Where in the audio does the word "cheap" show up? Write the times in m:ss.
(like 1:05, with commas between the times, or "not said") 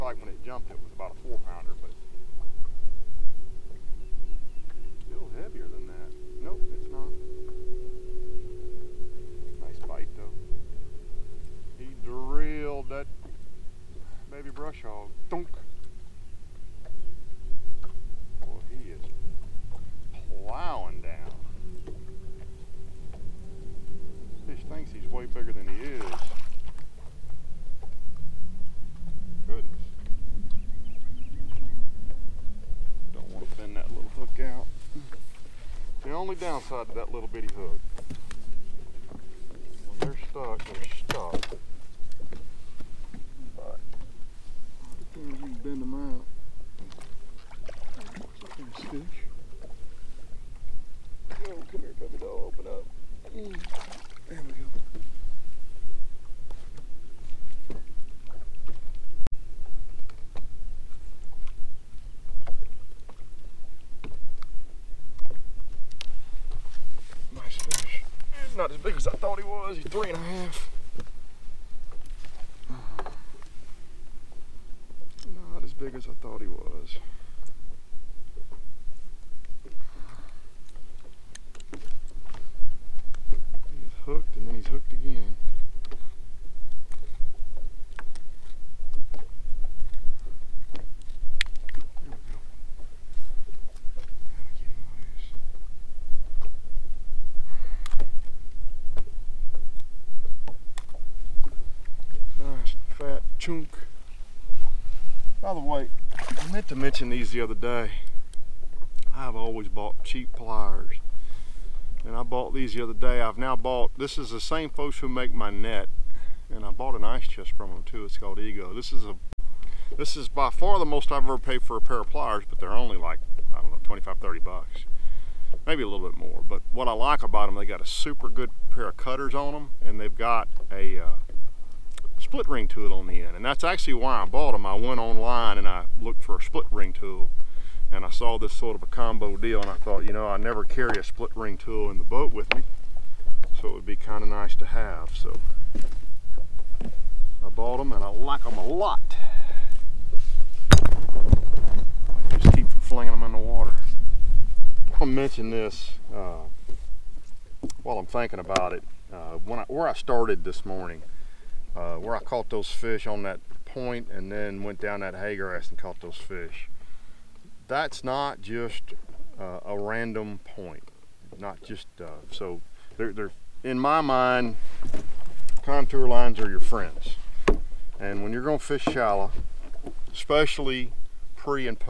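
1:50.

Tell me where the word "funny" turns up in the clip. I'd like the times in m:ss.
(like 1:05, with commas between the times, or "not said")
not said.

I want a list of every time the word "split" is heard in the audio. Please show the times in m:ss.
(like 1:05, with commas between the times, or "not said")
2:12, 2:16, 2:21.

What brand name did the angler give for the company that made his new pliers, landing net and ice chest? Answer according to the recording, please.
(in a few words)
Ego.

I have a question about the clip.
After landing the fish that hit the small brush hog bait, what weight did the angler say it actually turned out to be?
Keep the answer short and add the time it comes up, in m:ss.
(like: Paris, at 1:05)
3.5 pounds, at 1:09.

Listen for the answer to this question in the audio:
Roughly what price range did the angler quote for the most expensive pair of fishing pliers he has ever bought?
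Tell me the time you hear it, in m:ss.
2:03.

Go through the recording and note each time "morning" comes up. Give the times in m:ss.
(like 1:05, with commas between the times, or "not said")
2:40.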